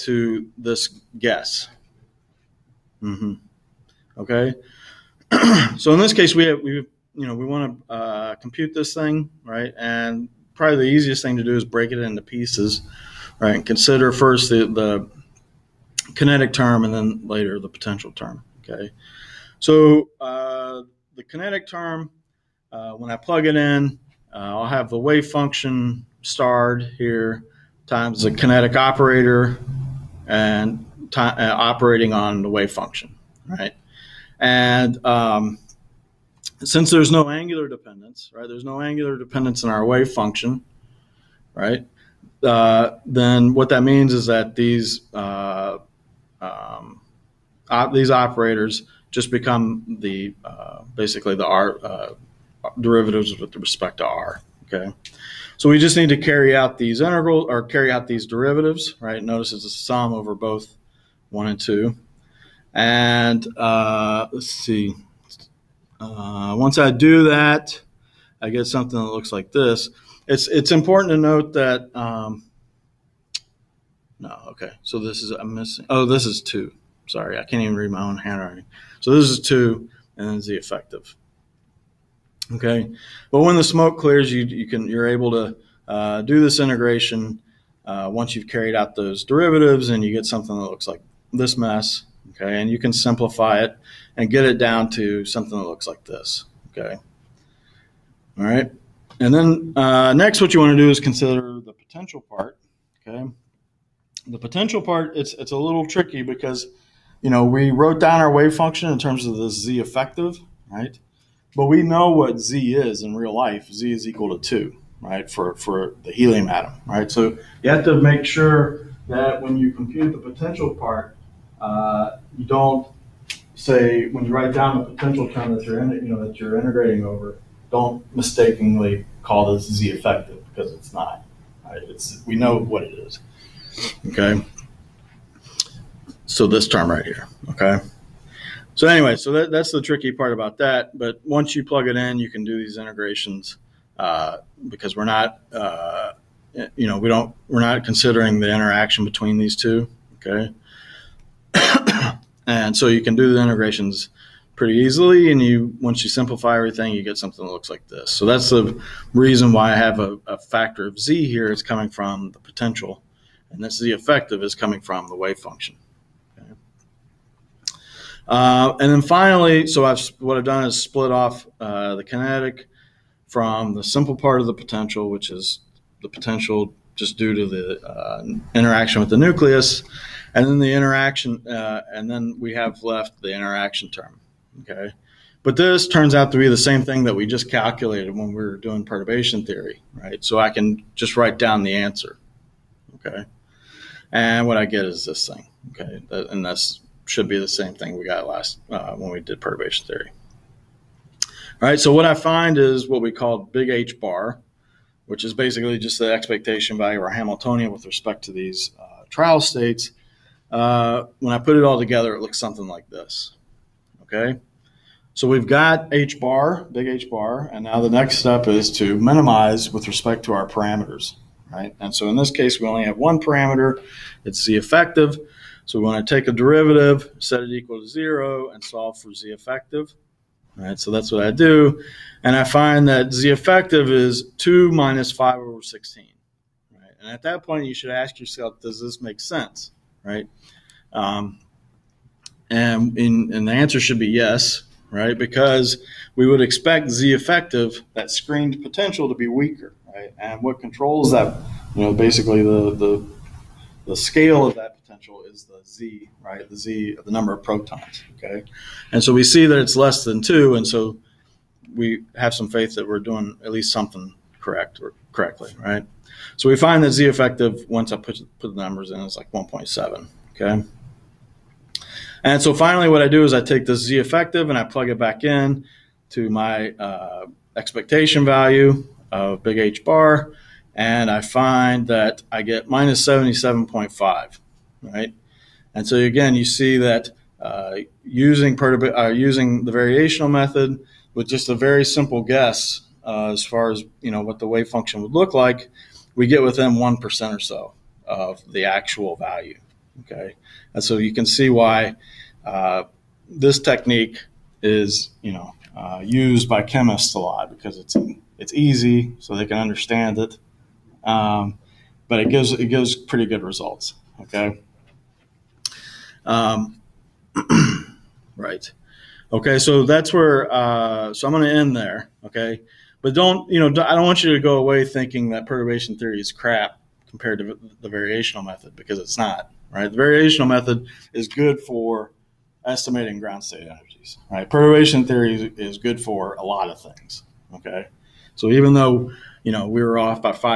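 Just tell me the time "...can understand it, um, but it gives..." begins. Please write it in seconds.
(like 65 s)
309 s.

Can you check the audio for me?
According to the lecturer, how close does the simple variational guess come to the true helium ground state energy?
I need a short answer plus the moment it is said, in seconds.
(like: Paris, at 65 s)
within one percent, at 296 s.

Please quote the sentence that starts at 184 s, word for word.
Okay, but this turns out to be the same thing that we just calculated when we were doing perturbation theory, right?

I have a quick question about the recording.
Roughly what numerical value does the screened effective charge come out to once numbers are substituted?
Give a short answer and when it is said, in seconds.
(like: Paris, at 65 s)
1.7, at 269 s.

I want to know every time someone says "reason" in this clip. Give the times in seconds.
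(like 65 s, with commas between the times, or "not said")
159 s.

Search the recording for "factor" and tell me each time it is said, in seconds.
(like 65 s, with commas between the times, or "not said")
160 s.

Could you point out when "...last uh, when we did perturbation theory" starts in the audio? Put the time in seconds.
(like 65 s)
198 s.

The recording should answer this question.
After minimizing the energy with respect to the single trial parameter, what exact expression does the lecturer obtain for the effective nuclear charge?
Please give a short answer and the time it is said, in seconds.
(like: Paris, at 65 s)
2 minus 5/16, at 234 s.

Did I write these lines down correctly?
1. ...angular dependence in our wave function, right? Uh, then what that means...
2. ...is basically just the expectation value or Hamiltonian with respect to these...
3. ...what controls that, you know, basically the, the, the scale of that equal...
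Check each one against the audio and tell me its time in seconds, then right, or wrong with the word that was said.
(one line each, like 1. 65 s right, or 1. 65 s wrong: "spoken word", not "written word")
1. 38 s right
2. 205 s right
3. 250 s wrong: "potential", not "equal".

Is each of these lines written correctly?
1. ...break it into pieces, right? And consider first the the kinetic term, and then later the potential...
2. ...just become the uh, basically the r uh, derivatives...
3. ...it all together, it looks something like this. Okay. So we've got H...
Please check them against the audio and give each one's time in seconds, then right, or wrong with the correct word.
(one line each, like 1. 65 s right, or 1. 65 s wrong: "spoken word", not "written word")
1. 11 s right
2. 49 s right
3. 211 s right.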